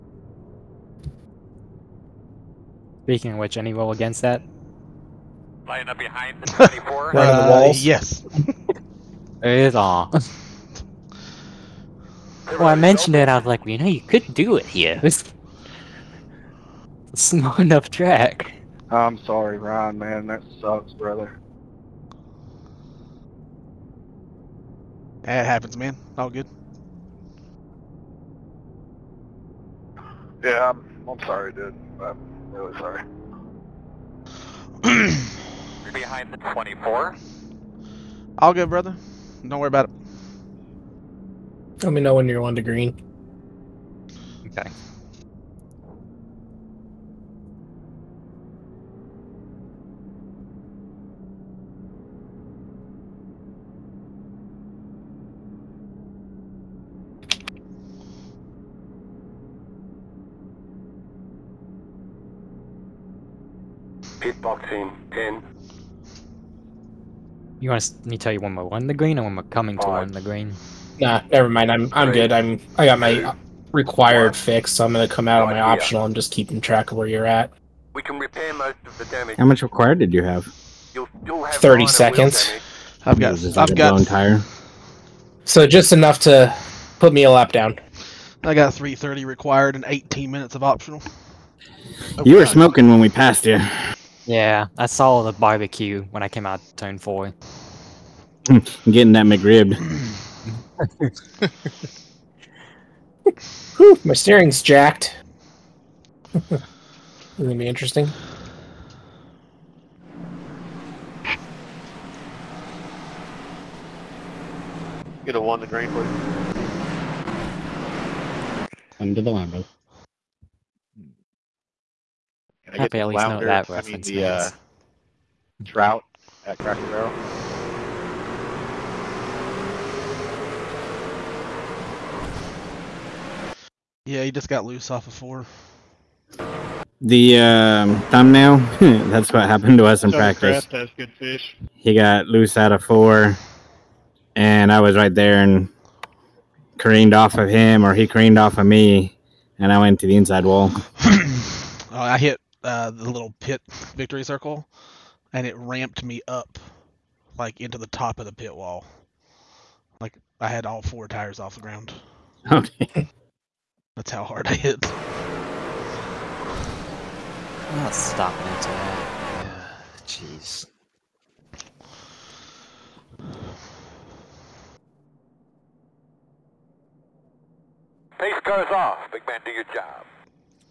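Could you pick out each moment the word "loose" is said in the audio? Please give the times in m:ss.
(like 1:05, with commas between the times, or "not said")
2:14, 2:22.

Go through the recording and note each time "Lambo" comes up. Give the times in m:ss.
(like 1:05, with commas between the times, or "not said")
1:59.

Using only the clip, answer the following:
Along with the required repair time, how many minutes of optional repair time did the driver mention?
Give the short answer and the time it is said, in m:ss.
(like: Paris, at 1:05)
18 minutes, at 1:29.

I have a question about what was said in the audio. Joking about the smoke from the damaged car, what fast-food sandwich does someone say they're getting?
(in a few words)
McRib.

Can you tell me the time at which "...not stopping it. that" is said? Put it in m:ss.
2:47.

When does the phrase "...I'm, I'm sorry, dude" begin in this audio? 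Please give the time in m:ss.
0:30.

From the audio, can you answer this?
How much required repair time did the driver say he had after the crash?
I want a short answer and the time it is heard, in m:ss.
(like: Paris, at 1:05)
3:30, at 1:28.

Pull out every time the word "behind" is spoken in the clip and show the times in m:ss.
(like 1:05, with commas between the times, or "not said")
0:05, 0:35.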